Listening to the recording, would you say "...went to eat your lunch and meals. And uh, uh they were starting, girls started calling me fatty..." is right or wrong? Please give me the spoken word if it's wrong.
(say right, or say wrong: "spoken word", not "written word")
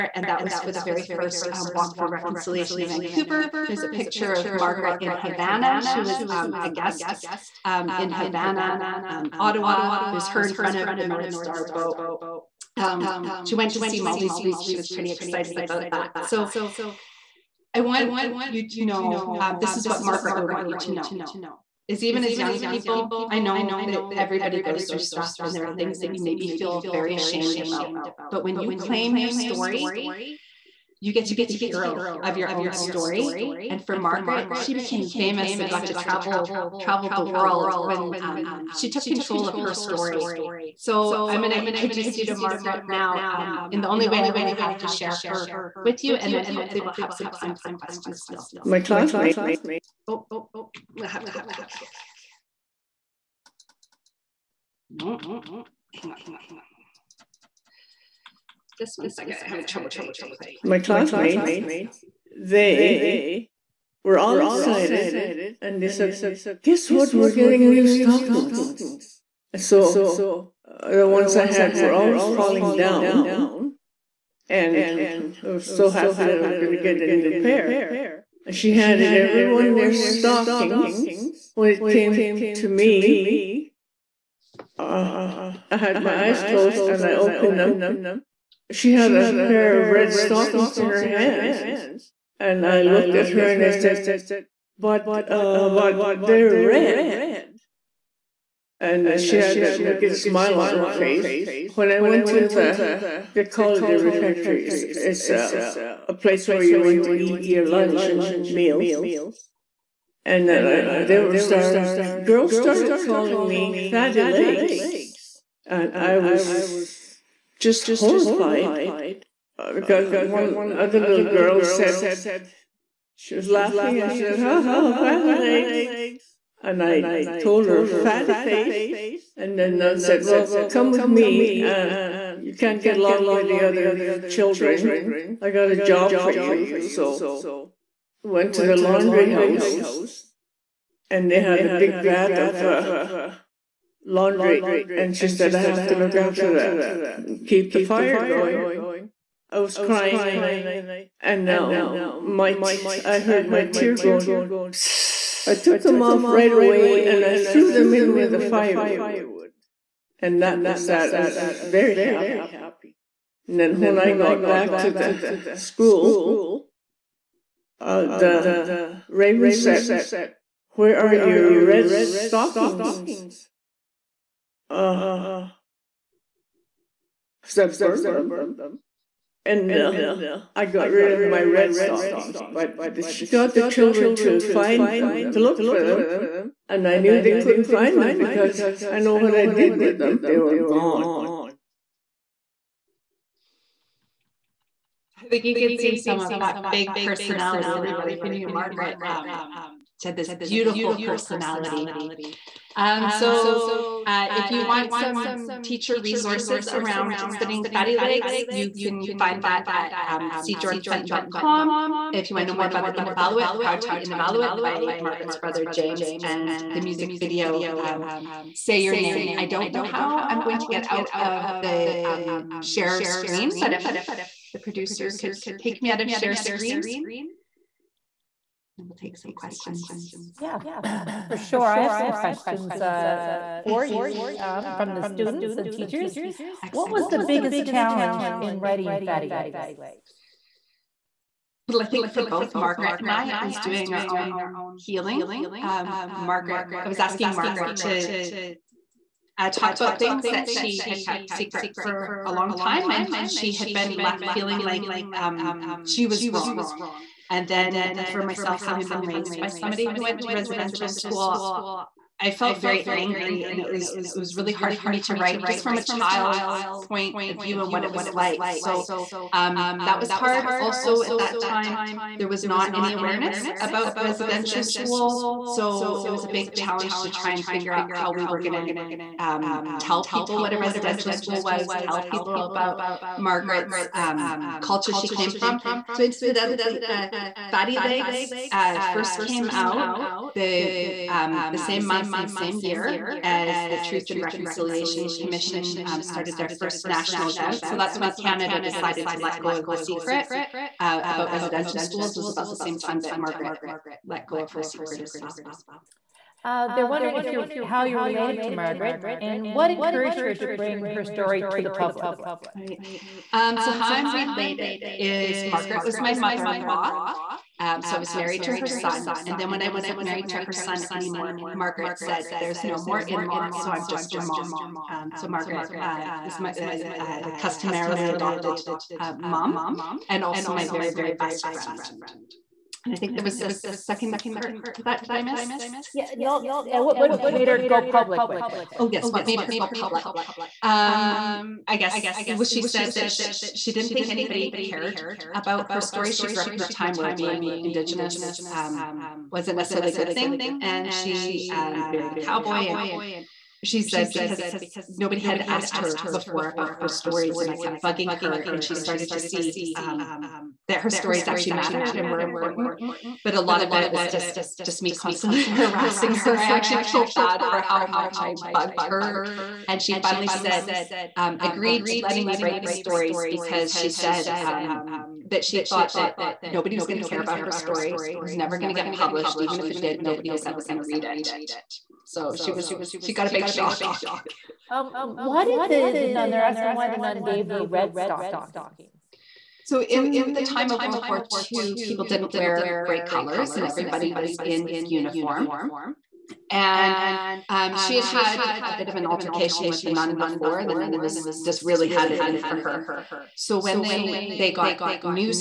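right.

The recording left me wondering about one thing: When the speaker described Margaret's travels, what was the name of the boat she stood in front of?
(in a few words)
North Star.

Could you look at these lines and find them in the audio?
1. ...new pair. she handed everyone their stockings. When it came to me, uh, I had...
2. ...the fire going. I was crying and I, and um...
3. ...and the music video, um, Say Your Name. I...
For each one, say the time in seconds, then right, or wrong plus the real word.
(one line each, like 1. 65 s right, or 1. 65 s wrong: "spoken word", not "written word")
1. 77 s right
2. 147 s right
3. 216 s right.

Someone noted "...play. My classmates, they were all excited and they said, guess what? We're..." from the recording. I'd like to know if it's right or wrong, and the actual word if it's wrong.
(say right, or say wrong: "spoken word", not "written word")
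right.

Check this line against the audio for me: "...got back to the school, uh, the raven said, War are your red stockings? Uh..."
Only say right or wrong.
wrong.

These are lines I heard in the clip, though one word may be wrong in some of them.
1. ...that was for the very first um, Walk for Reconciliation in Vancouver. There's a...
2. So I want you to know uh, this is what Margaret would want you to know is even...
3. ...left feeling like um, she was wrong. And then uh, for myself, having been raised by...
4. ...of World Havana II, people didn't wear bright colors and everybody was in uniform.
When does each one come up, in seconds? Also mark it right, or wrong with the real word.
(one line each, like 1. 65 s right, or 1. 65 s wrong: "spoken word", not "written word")
1. 0 s right
2. 16 s right
3. 253 s right
4. 390 s wrong: "War", not "Havana".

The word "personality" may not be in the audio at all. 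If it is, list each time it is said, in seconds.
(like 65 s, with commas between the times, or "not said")
196 s, 201 s.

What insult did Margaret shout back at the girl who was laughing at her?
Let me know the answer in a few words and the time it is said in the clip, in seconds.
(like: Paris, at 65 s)
Fatty face, at 127 s.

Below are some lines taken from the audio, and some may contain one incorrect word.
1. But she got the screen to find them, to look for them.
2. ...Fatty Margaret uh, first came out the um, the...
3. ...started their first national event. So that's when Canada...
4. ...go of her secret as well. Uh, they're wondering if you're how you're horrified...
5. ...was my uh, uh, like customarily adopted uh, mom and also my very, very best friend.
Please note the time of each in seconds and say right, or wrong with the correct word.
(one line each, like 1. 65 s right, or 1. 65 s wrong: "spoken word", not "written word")
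1. 182 s wrong: "children", not "screen"
2. 287 s wrong: "Legs", not "Margaret"
3. 296 s right
4. 304 s wrong: "related", not "horrified"
5. 326 s right.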